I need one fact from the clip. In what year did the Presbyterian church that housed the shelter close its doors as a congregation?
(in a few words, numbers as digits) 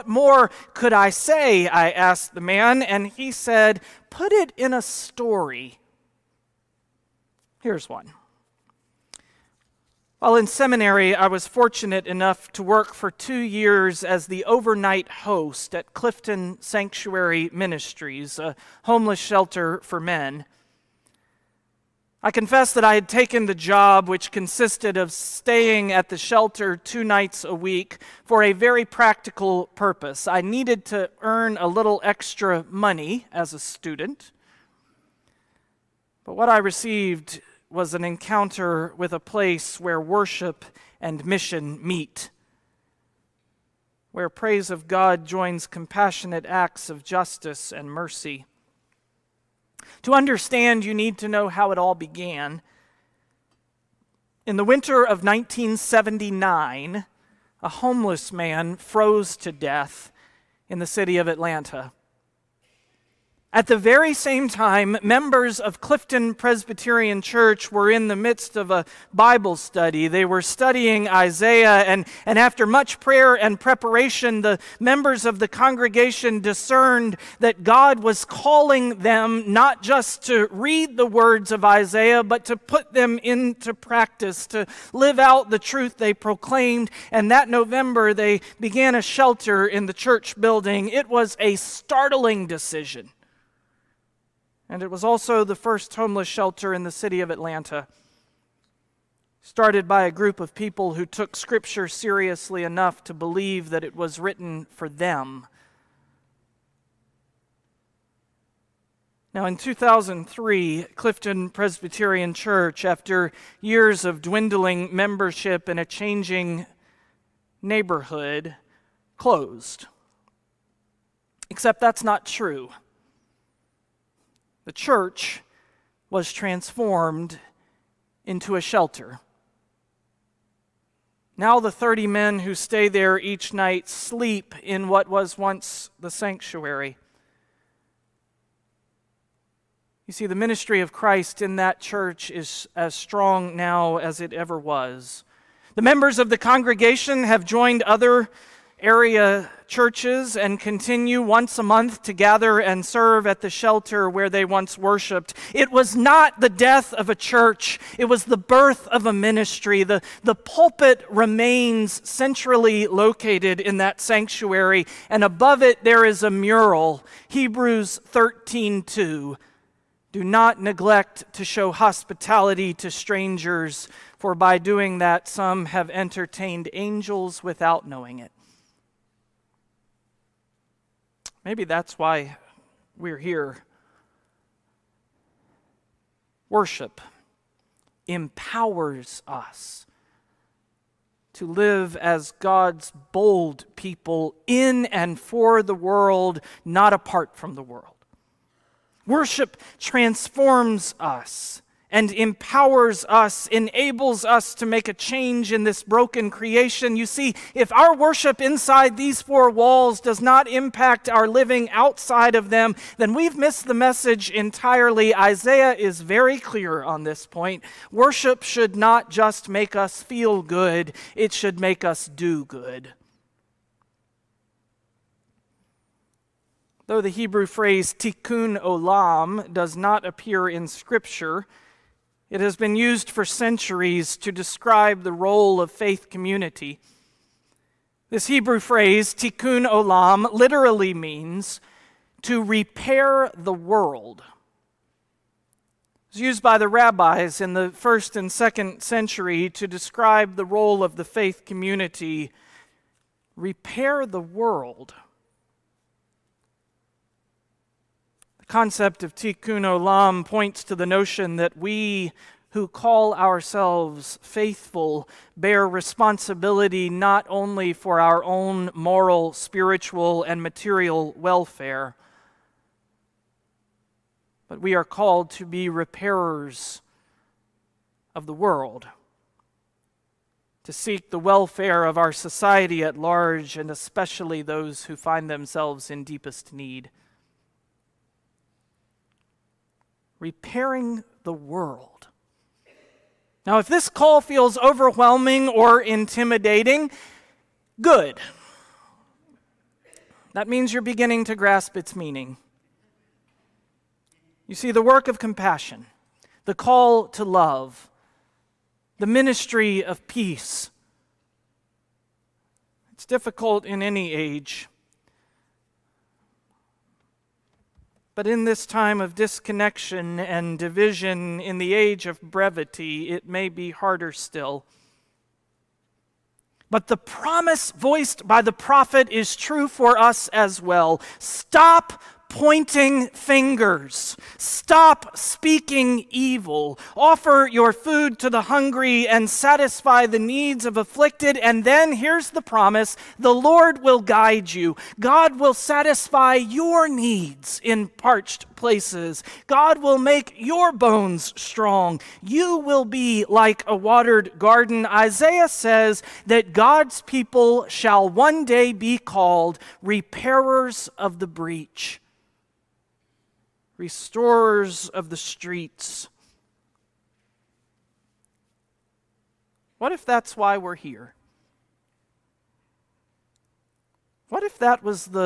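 2003.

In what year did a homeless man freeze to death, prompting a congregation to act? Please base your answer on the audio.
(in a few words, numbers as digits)
1979.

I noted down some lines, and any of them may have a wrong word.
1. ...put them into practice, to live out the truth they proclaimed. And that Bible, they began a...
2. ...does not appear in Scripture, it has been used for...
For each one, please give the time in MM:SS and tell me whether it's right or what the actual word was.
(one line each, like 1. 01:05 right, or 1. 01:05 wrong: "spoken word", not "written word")
1. 01:22 wrong: "November", not "Bible"
2. 03:49 right.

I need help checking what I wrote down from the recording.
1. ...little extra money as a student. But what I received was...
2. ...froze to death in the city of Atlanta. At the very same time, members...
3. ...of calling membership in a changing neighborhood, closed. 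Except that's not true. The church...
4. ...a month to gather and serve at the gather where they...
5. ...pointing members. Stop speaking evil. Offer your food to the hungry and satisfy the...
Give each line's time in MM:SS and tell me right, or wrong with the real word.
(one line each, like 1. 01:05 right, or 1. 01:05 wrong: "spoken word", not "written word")
1. 00:31 right
2. 00:58 right
3. 01:54 wrong: "dwindling", not "calling"
4. 02:31 wrong: "shelter", not "gather"
5. 05:32 wrong: "fingers", not "members".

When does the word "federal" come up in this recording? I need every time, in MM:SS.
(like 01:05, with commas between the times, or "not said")
not said.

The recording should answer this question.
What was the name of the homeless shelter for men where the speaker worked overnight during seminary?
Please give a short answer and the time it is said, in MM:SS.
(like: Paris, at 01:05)
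Clifton Sanctuary Ministries, at 00:15.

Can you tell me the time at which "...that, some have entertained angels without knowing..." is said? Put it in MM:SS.
02:54.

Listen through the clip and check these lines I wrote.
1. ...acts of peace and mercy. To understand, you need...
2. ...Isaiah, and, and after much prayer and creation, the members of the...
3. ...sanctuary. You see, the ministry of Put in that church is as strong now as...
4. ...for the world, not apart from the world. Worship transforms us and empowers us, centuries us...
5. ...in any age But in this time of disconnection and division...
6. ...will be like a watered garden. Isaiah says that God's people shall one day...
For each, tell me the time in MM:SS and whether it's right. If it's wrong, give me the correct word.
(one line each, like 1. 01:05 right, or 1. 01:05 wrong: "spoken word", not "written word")
1. 00:46 wrong: "justice", not "peace"
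2. 01:11 wrong: "preparation", not "creation"
3. 02:16 wrong: "Christ", not "Put"
4. 03:15 wrong: "enables", not "centuries"
5. 05:13 right
6. 05:52 right.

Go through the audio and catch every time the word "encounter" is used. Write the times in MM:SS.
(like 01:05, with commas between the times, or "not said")
00:38.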